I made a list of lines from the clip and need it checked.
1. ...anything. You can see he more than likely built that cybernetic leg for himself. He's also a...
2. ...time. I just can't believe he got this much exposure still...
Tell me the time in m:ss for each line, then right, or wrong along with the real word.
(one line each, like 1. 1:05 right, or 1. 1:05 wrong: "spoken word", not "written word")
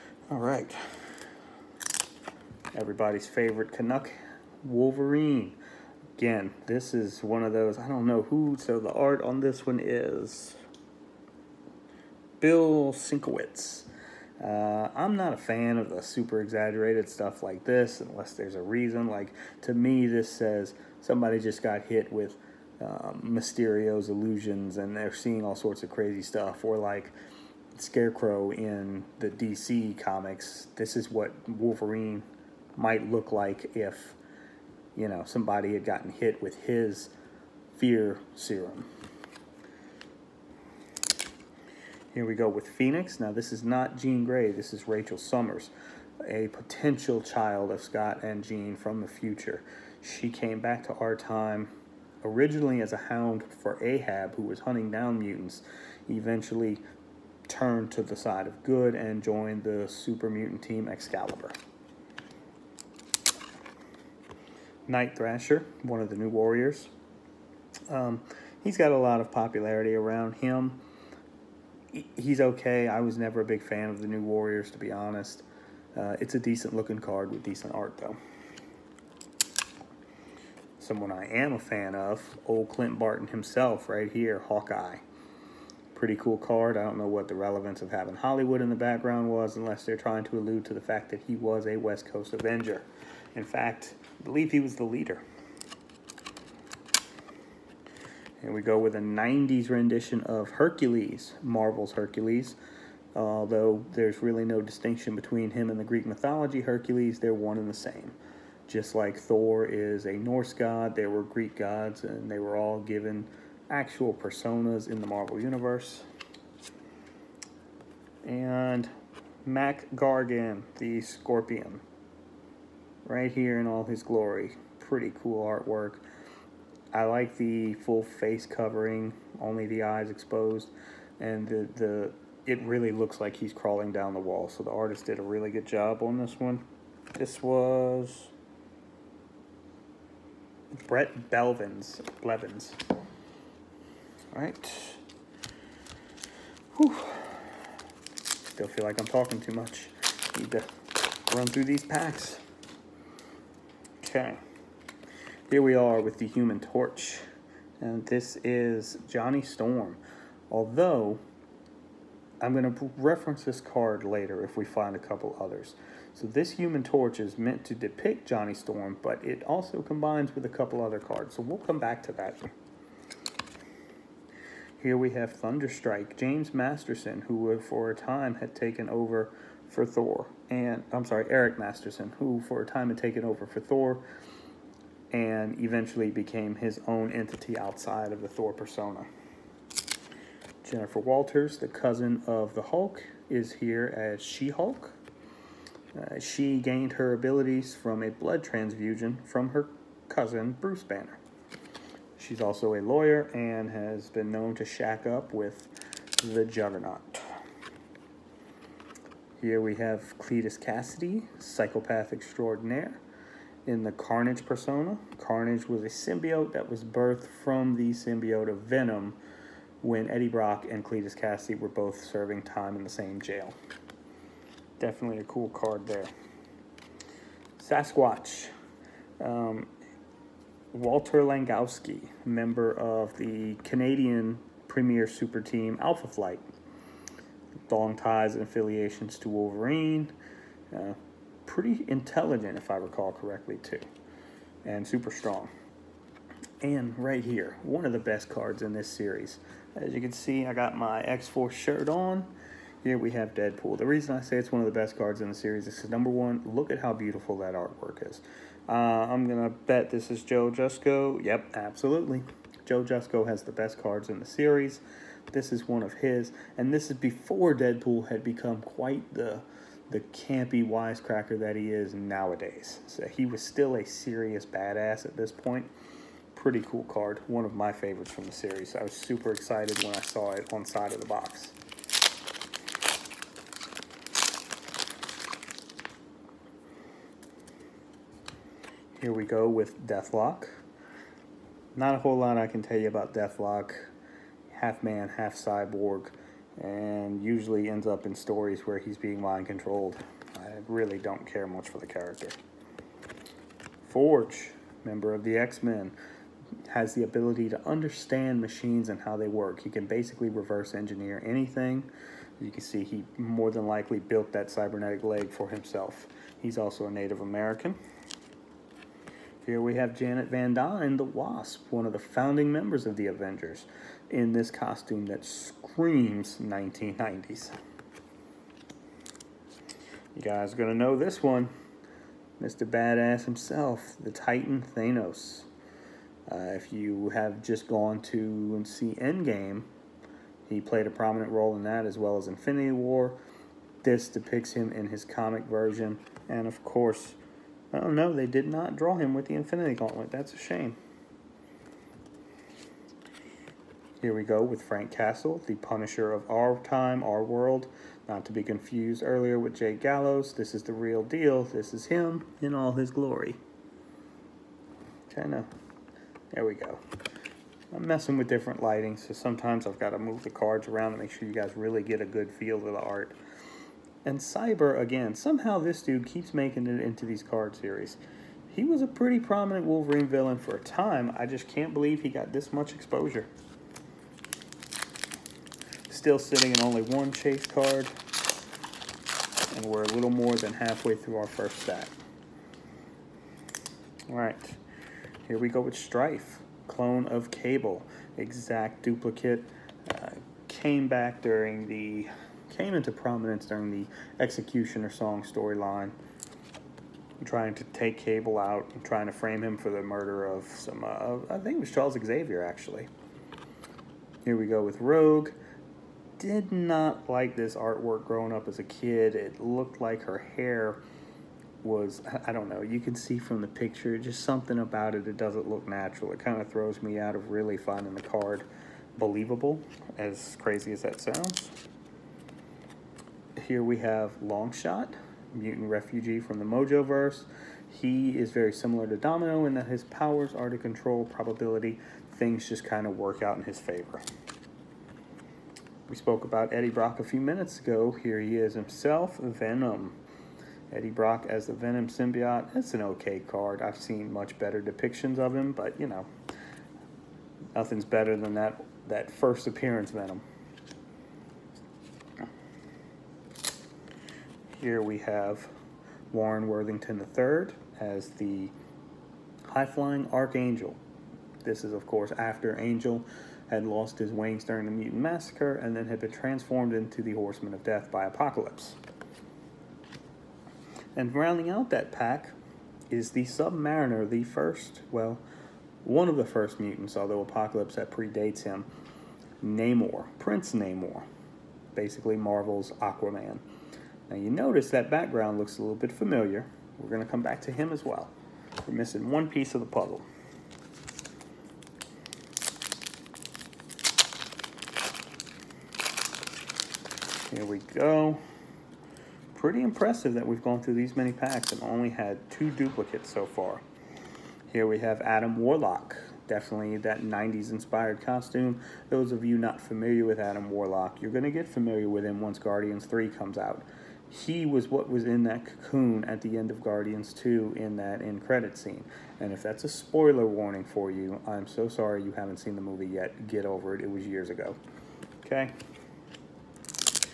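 1. 5:11 right
2. 6:20 right.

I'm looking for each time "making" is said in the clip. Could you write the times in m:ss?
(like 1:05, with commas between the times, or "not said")
6:16.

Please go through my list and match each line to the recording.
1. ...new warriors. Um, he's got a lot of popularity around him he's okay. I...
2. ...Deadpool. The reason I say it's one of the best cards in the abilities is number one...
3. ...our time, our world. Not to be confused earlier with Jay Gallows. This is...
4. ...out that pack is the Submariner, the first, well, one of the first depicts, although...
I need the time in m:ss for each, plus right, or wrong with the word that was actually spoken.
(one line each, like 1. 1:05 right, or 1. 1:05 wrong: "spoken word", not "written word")
1. 1:06 right
2. 4:13 wrong: "series", not "abilities"
3. 5:56 right
4. 8:01 wrong: "mutants", not "depicts".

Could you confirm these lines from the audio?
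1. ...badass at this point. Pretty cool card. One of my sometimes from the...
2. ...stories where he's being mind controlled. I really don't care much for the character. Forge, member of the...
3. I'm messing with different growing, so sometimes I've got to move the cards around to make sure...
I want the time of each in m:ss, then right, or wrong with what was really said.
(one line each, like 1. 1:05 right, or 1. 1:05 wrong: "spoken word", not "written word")
1. 4:34 wrong: "favorites", not "sometimes"
2. 4:58 right
3. 6:07 wrong: "lighting", not "growing".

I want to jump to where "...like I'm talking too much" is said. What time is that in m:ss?
2:28.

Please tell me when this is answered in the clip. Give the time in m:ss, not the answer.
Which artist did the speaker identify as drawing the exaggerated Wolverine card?
0:12.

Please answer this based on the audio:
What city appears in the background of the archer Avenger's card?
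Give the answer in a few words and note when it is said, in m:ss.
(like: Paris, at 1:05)
Hollywood, at 1:28.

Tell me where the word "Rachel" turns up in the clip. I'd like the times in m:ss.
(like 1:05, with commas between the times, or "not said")
0:44.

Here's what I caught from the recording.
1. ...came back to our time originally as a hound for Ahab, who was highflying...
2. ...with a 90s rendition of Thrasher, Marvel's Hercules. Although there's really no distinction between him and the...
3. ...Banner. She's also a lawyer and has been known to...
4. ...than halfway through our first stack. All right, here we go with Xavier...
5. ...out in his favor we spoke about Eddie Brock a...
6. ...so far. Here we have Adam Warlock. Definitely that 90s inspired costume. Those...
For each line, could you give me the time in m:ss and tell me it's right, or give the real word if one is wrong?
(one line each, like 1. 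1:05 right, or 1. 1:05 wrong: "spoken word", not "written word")
1. 0:50 wrong: "hunting", not "highflying"
2. 1:38 wrong: "Hercules", not "Thrasher"
3. 3:20 right
4. 6:30 wrong: "Strife", not "Xavier"
5. 7:23 right
6. 8:33 right.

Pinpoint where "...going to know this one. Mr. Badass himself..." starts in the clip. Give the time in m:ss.
5:30.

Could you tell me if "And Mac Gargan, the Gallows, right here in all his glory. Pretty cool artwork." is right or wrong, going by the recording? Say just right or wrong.
wrong.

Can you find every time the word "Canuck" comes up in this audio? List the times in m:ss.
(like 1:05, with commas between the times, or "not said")
0:03.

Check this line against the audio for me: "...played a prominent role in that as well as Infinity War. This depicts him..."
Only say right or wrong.
right.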